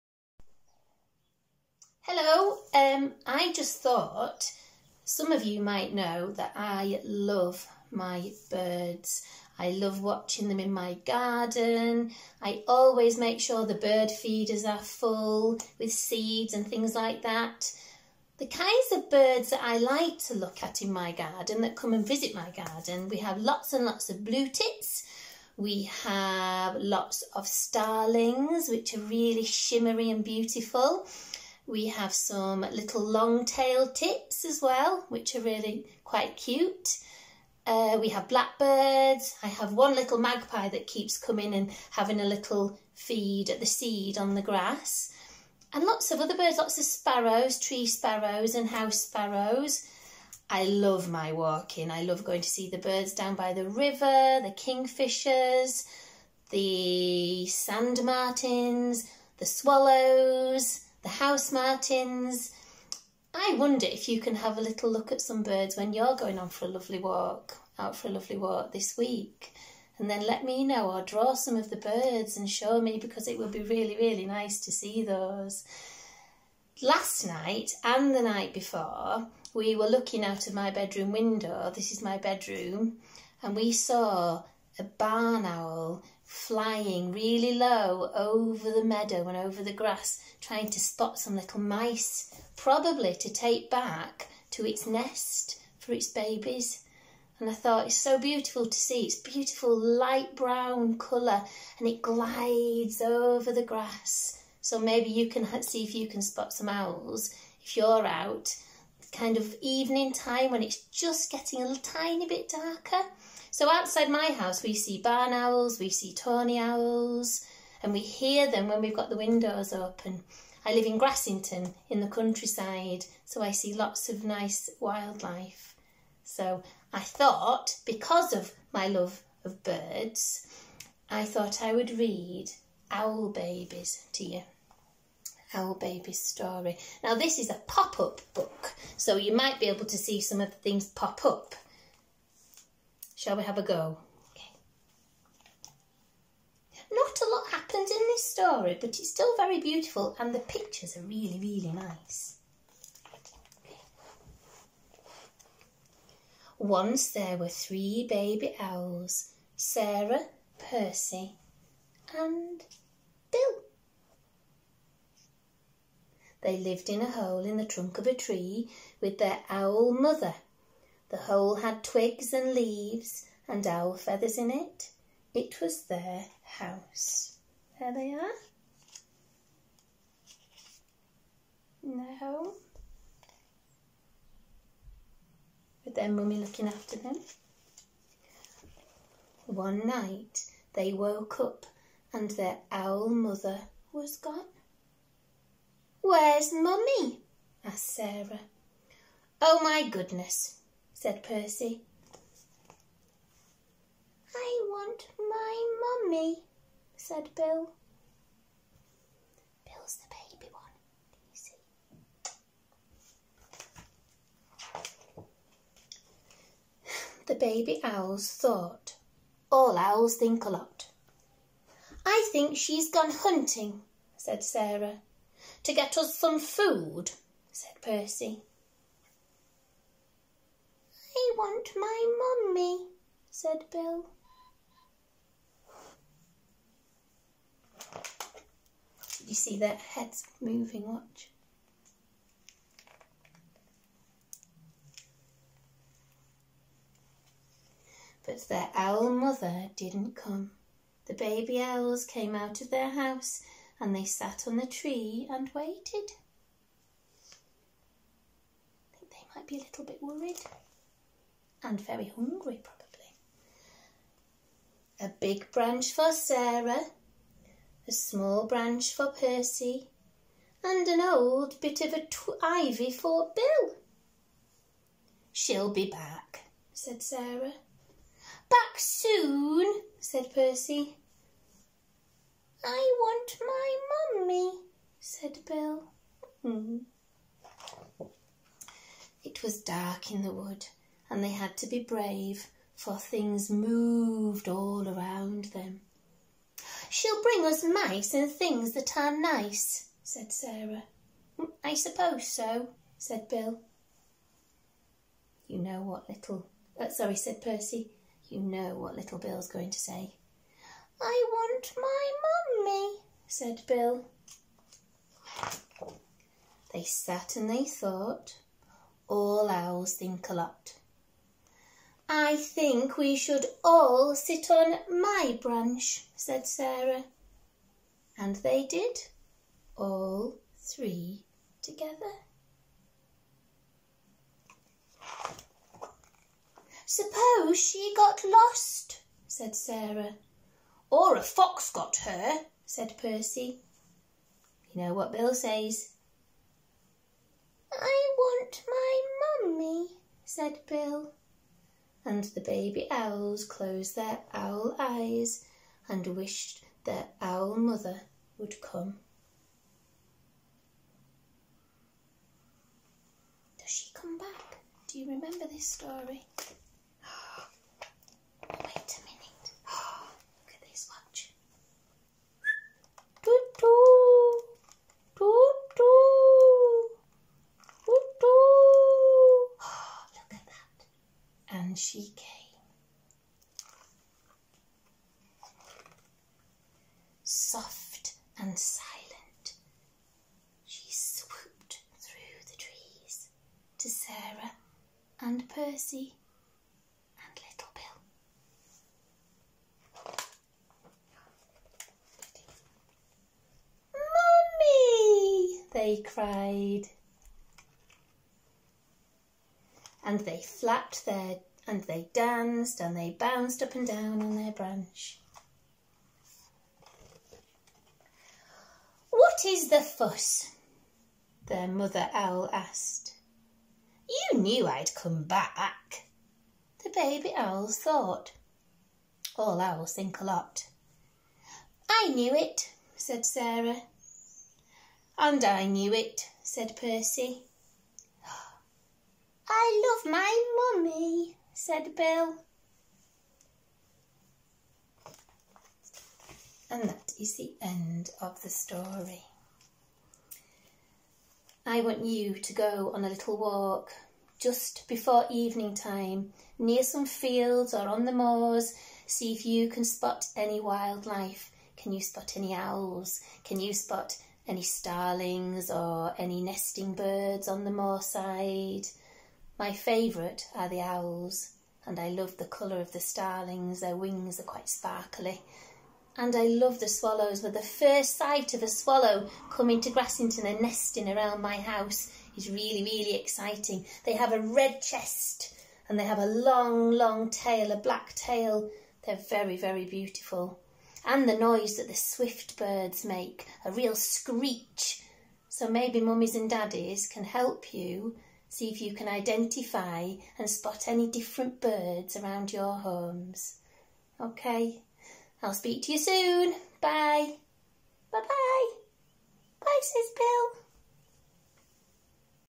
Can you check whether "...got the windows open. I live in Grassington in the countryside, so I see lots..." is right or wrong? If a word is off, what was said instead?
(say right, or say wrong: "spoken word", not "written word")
right.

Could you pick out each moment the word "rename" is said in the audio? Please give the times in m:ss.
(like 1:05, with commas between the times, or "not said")
not said.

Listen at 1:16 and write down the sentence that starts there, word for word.
Last night and the night before, we were looking out of my bedroom window.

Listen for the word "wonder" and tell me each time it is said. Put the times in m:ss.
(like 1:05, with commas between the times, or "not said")
1:03.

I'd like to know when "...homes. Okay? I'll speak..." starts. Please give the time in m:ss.
8:22.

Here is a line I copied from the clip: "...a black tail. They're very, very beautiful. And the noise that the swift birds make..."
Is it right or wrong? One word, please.
right.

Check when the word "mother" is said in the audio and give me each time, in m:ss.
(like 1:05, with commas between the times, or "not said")
2:49, 3:13, 4:09, 5:57, 7:01.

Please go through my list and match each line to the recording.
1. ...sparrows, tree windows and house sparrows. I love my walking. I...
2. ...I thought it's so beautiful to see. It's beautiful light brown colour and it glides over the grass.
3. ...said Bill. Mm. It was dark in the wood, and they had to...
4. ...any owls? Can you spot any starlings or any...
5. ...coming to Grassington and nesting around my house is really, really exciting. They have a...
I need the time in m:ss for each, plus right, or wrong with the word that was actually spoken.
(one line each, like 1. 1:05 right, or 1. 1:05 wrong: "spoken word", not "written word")
1. 0:46 wrong: "sparrows", not "windows"
2. 1:37 right
3. 4:44 right
4. 7:42 right
5. 7:59 right.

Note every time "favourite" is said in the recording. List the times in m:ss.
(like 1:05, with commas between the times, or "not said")
7:49.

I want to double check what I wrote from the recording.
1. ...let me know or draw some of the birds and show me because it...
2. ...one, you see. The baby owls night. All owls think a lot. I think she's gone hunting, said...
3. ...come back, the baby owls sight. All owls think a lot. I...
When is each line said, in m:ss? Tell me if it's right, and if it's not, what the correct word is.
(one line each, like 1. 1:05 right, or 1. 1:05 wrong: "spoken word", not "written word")
1. 1:10 right
2. 3:30 wrong: "thought", not "night"
3. 7:04 wrong: "thought", not "sight".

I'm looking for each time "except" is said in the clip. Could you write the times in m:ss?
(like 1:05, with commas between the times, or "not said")
not said.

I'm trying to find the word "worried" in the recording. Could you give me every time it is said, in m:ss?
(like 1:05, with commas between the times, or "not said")
4:20.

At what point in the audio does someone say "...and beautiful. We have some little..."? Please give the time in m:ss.
0:30.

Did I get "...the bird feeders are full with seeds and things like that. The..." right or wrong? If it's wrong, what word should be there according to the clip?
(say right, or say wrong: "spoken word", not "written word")
right.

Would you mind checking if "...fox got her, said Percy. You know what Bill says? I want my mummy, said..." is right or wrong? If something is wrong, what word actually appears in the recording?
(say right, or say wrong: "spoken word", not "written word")
right.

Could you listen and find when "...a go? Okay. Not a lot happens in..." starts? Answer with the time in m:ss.
2:23.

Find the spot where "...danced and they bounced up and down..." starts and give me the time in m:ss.
6:52.